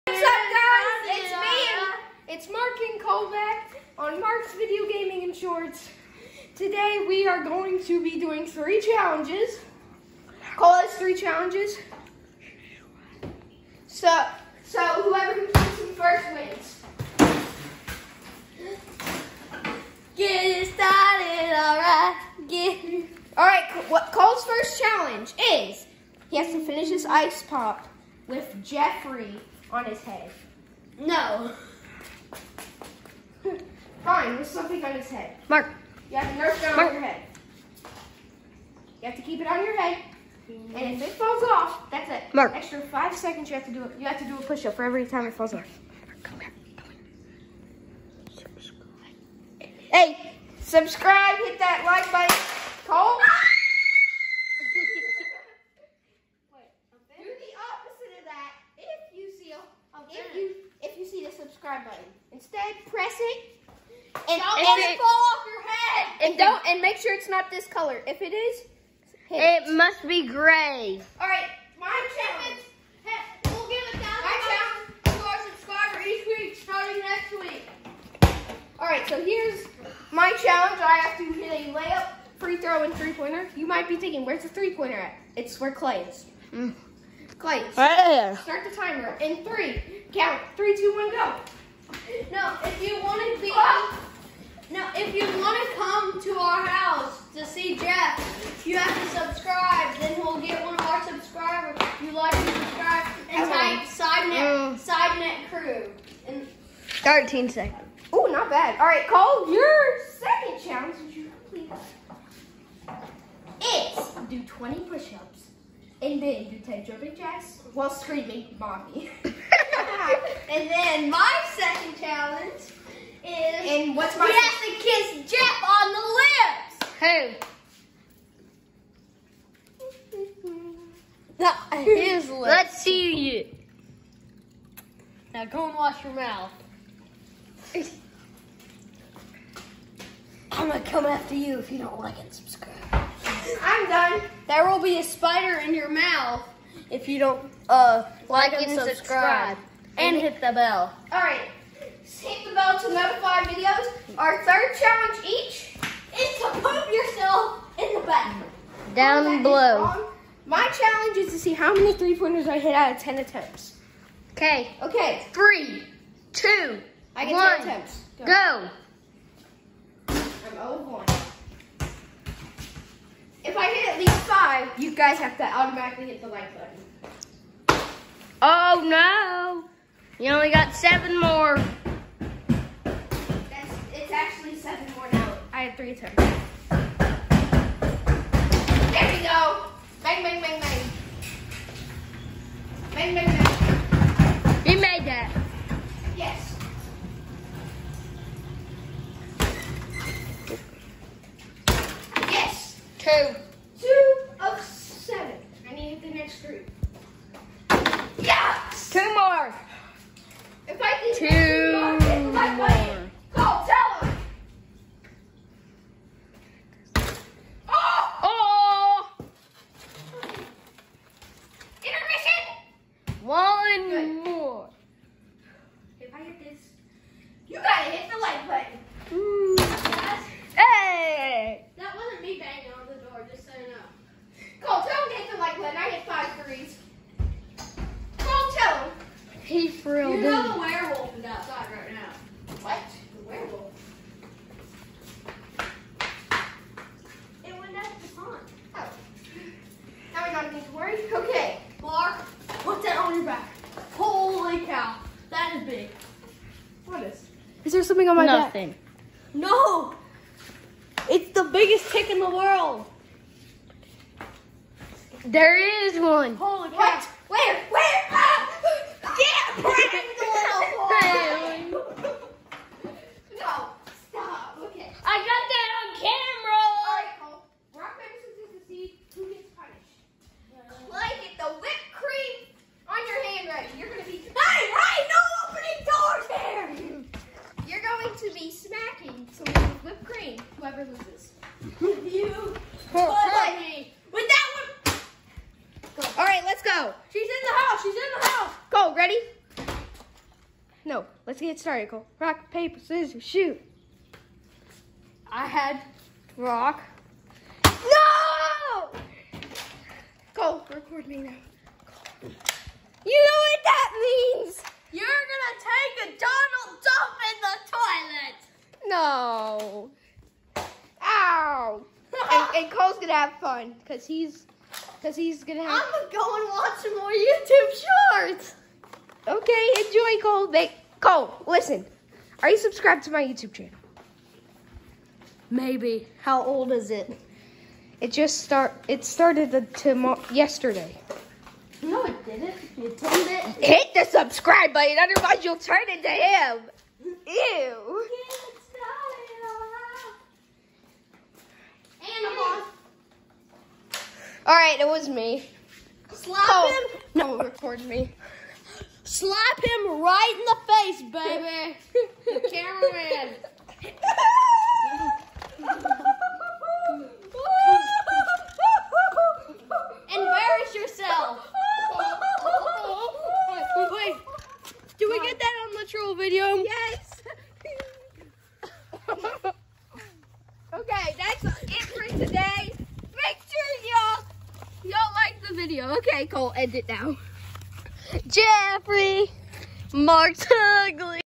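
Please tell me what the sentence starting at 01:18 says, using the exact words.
All right, so here's my challenge.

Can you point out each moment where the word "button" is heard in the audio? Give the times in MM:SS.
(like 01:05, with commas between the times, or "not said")
00:52, 01:01, 02:38, 02:56, 03:48, 05:44.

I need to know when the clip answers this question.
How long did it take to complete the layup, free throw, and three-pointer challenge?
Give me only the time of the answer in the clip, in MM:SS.
01:47.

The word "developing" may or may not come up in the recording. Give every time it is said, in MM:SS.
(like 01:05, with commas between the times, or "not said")
not said.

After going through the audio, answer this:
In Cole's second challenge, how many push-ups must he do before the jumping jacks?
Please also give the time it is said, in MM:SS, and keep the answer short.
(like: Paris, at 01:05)
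20, at 01:54.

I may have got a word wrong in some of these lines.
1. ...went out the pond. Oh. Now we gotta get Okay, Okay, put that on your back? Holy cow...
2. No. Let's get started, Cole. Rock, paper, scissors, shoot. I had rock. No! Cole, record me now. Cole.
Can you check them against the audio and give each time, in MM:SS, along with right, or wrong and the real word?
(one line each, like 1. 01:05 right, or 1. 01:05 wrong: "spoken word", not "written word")
1. 04:07 wrong: "Mark", not "Okay"
2. 05:00 right.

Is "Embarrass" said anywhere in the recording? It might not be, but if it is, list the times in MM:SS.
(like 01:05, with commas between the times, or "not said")
06:10.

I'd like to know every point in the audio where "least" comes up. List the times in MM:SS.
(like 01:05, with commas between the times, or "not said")
02:53.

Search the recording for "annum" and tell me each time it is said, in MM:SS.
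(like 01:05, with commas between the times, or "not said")
not said.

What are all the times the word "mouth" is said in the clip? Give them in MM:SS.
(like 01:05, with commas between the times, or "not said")
02:16, 02:25.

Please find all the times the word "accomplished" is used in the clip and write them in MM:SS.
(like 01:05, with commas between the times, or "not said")
not said.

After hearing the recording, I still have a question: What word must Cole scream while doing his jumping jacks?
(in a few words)
Mommy.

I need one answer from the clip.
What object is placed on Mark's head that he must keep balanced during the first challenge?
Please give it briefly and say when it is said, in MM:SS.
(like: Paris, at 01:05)
Nerf gun, at 00:36.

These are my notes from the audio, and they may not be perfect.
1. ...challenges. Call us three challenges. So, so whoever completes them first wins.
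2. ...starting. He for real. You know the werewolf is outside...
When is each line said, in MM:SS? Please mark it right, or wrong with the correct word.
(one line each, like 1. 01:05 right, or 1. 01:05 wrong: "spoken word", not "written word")
1. 00:08 right
2. 03:53 wrong: "saying", not "starting".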